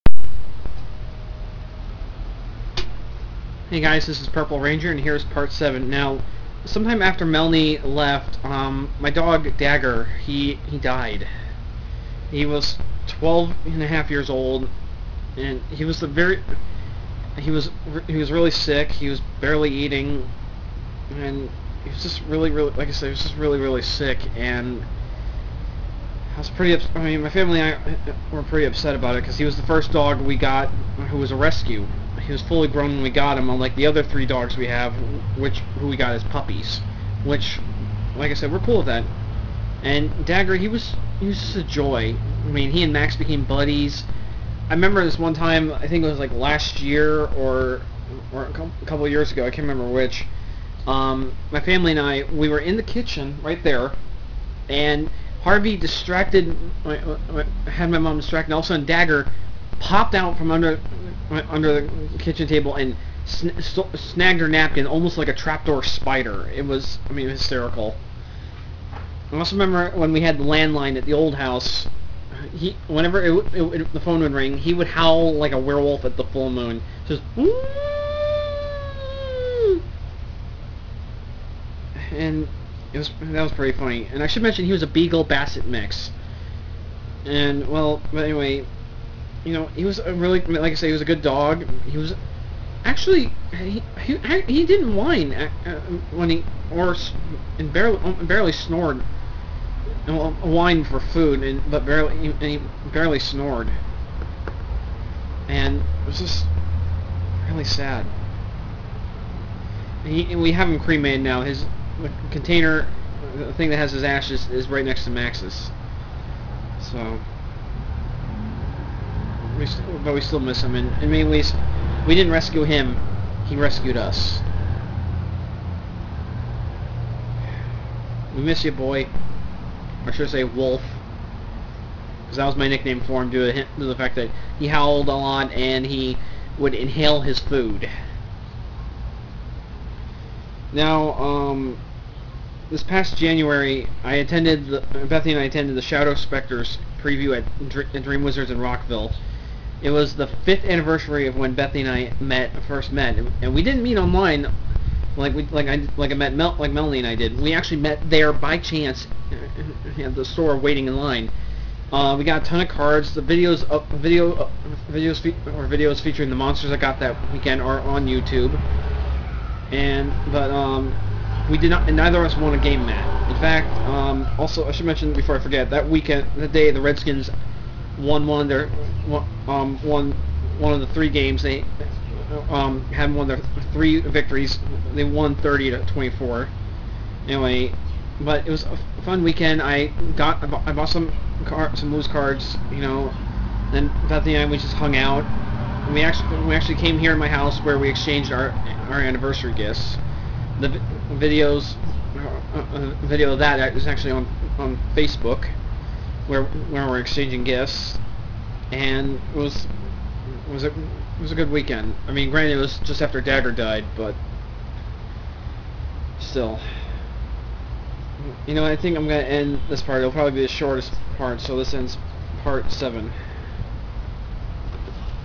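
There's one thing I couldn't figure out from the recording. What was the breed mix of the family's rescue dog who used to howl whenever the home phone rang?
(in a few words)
Beagle basset mix.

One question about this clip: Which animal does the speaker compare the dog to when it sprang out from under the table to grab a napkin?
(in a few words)
Trapdoor spider.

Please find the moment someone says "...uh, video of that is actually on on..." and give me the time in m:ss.
3:22.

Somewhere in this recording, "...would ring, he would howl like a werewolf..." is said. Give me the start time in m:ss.
1:14.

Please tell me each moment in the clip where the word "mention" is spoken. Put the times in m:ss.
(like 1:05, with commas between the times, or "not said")
1:24, 2:54.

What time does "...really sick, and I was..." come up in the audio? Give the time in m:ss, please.
0:23.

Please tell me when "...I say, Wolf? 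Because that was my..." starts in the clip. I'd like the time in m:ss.
2:10.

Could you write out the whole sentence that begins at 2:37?
We actually met there by chance at the store waiting in line.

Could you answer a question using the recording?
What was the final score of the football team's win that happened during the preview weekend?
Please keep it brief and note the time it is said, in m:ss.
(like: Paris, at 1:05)
30 to 24, at 3:05.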